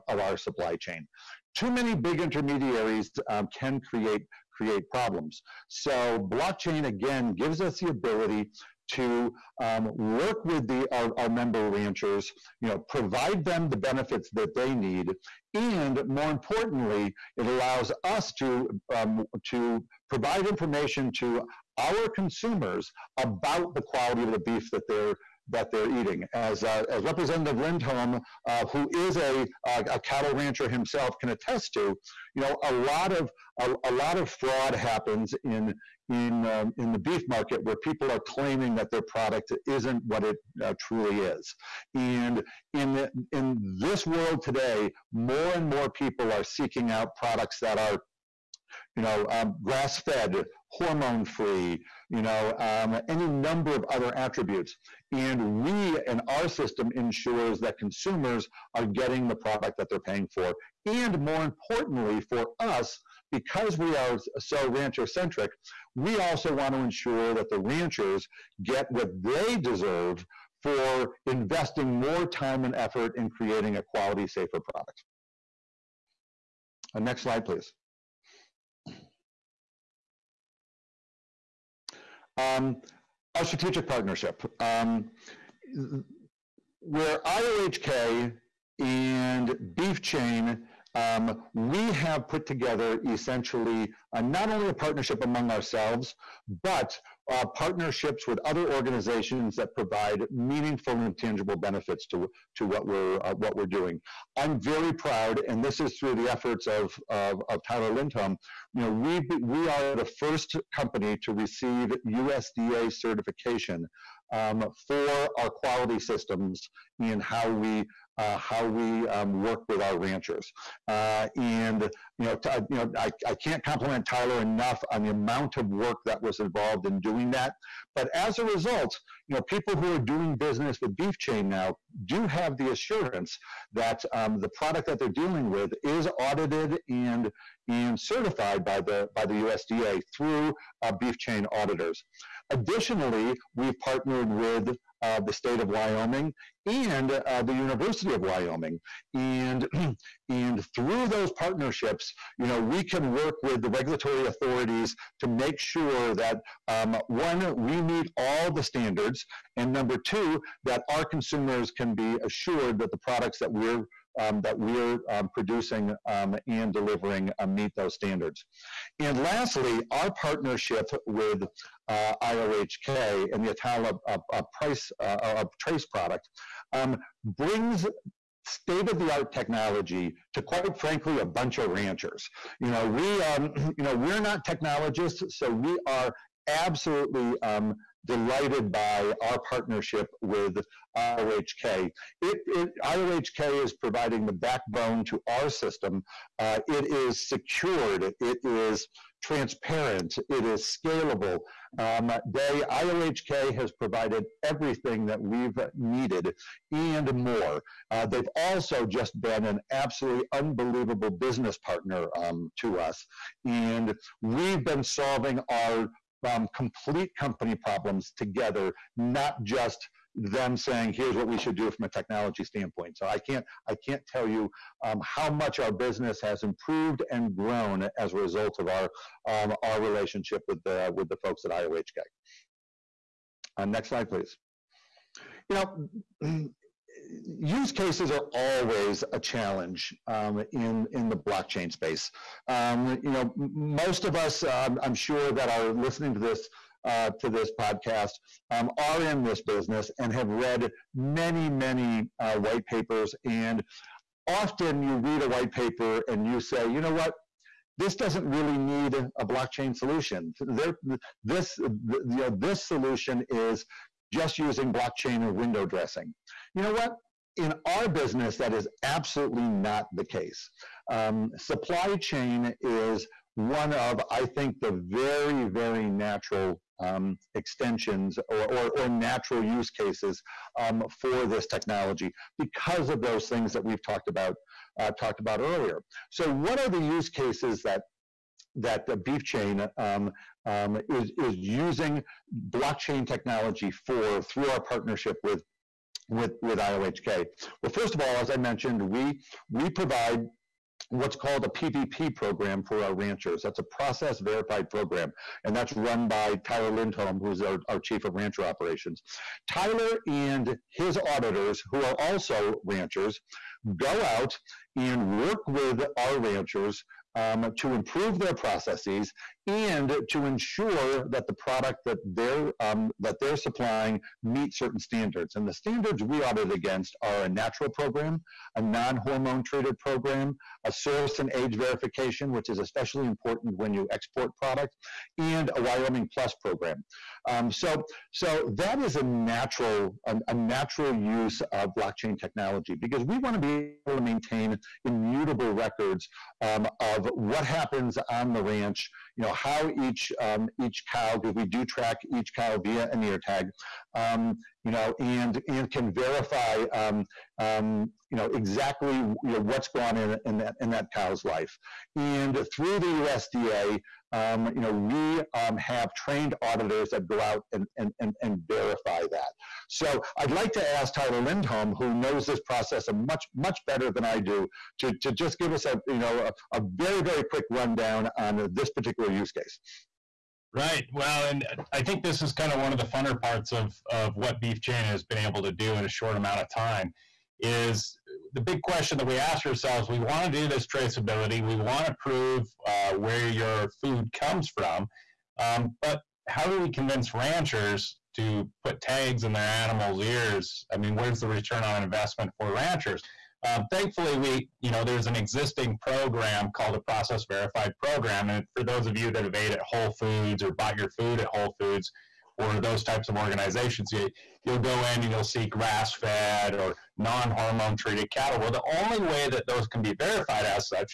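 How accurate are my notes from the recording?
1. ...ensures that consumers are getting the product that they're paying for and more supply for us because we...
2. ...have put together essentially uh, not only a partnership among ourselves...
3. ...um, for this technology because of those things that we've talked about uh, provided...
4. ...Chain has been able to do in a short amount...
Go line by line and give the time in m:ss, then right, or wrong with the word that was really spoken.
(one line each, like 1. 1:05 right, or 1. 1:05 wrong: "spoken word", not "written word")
1. 0:56 wrong: "importantly", not "supply"
2. 1:31 right
3. 4:40 wrong: "talked", not "provided"
4. 6:24 right.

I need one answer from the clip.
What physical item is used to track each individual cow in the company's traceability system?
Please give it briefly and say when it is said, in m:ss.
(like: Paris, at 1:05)
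An ear tag, at 5:52.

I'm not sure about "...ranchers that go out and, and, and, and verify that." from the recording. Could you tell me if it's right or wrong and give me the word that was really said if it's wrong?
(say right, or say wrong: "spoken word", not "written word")
wrong: "auditors", not "ranchers".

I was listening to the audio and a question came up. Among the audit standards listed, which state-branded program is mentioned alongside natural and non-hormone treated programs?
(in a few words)
Wyoming Plus.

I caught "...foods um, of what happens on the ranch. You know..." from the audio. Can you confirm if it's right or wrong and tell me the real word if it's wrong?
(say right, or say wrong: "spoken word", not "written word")
wrong: "records", not "foods".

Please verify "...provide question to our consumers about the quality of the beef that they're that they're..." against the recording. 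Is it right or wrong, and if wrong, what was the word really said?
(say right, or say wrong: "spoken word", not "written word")
wrong: "information", not "question".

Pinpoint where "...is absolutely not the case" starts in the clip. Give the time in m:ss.
4:28.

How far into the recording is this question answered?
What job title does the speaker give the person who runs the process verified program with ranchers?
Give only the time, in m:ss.
5:07.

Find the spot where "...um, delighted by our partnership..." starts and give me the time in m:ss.
3:07.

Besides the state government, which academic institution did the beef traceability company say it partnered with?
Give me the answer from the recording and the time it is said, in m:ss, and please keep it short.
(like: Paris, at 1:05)
University of Wyoming, at 2:27.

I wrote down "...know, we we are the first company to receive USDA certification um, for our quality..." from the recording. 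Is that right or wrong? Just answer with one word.
right.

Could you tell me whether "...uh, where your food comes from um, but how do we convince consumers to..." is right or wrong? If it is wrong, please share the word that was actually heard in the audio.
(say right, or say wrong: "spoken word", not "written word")
wrong: "ranchers", not "consumers".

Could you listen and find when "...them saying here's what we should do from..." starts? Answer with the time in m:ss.
3:40.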